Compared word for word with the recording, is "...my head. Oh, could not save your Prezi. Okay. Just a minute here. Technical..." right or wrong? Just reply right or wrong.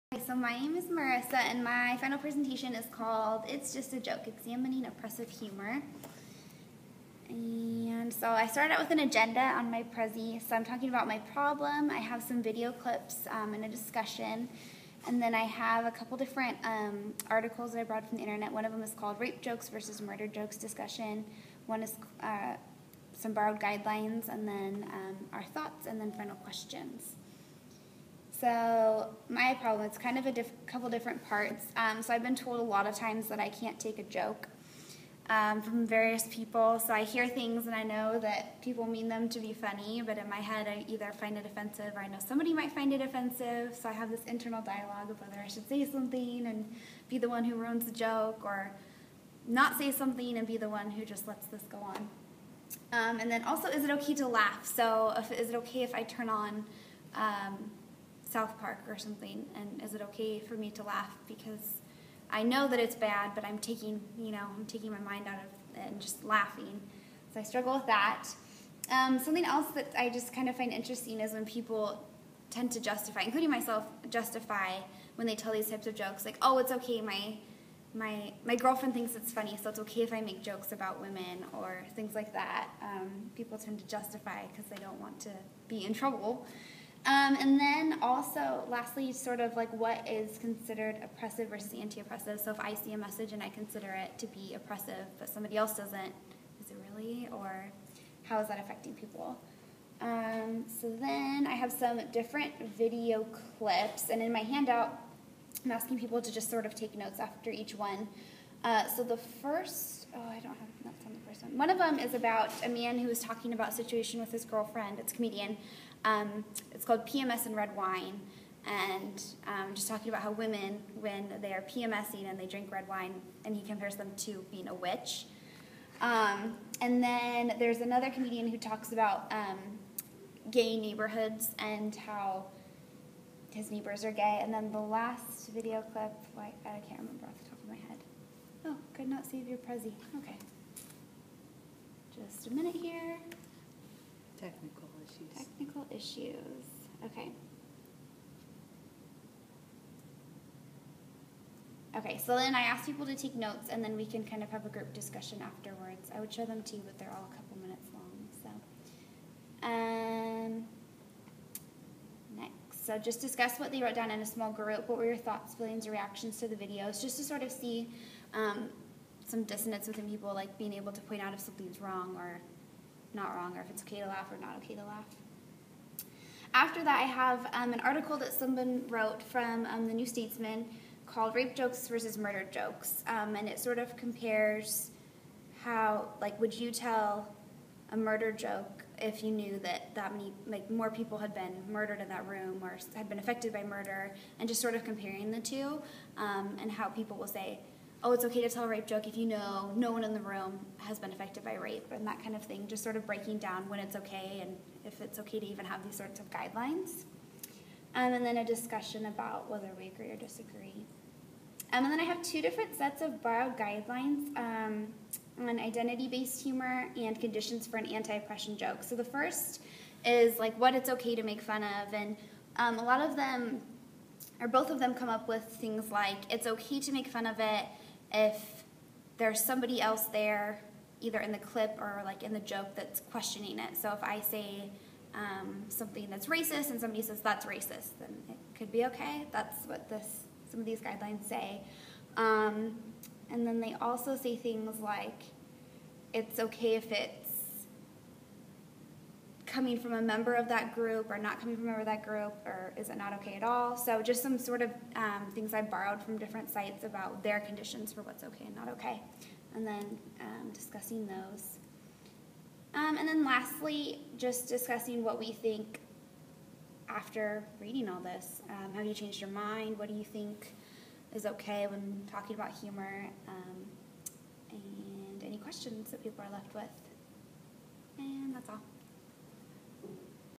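right.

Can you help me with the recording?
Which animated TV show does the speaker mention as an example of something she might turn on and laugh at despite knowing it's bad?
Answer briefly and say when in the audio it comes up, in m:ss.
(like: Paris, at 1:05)
South Park, at 0:58.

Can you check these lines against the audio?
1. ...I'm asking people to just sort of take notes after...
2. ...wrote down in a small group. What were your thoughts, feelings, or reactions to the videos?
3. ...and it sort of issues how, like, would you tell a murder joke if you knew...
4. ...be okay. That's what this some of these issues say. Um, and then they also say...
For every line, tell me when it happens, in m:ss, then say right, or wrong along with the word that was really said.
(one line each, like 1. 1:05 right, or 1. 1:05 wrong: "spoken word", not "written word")
1. 1:45 right
2. 2:43 right
3. 3:03 wrong: "compares", not "issues"
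4. 3:58 wrong: "guidelines", not "issues".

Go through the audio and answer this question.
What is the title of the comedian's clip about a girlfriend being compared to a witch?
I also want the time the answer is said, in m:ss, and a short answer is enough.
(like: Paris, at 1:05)
PMS and Red Wine, at 1:57.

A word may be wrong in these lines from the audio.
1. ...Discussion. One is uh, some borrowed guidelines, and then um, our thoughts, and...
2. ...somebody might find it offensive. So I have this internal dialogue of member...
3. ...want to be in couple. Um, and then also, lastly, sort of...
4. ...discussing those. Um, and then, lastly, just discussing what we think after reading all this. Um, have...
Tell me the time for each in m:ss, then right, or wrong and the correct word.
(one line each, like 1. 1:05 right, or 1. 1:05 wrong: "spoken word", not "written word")
1. 0:20 right
2. 0:42 wrong: "whether", not "member"
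3. 1:25 wrong: "trouble", not "couple"
4. 4:20 right.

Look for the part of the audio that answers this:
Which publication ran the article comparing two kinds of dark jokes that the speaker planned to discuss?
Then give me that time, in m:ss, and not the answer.
2:59.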